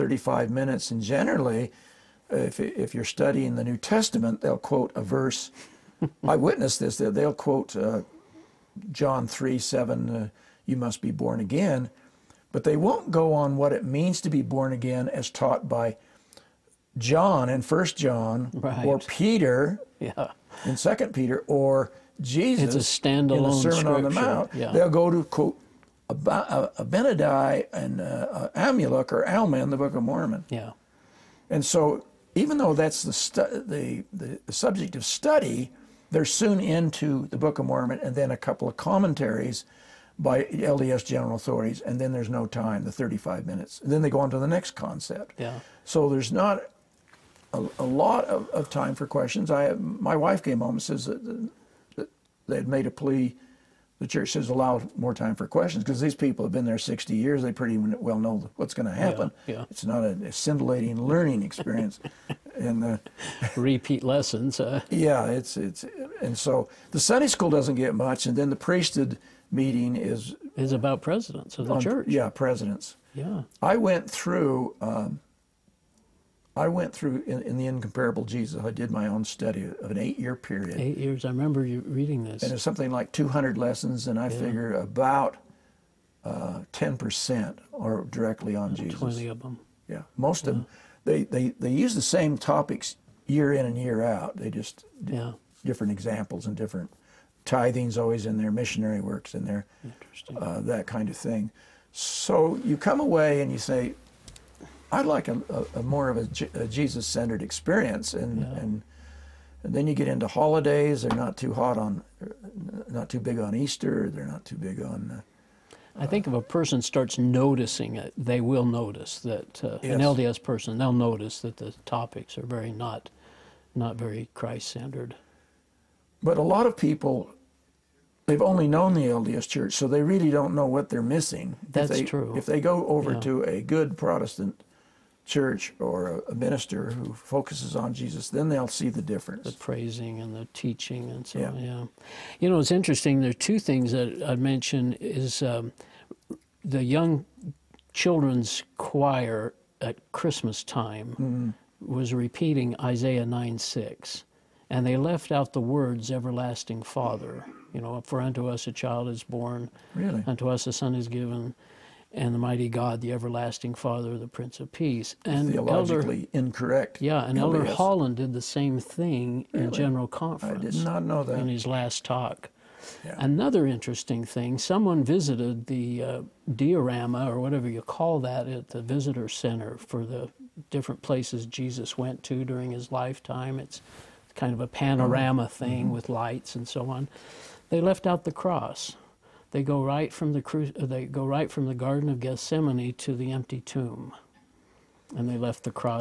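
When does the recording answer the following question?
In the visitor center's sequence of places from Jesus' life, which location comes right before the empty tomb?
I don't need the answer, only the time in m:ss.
3:11.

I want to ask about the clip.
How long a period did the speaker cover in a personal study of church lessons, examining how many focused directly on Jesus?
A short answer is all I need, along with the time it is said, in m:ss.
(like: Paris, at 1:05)
8 years, at 1:19.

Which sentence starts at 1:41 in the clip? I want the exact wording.
So you come away and you say, I'd like a, a, a more of a, Jesus-centered experience, and, yeah.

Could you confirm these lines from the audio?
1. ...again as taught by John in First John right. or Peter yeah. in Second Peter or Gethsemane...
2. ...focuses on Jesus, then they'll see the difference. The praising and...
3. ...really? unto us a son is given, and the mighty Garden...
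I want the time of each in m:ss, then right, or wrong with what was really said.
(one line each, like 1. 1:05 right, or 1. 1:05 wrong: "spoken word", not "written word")
1. 0:14 wrong: "Jesus", not "Gethsemane"
2. 2:17 right
3. 2:39 wrong: "God", not "Garden".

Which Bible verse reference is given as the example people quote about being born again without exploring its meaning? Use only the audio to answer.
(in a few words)
John 3:7.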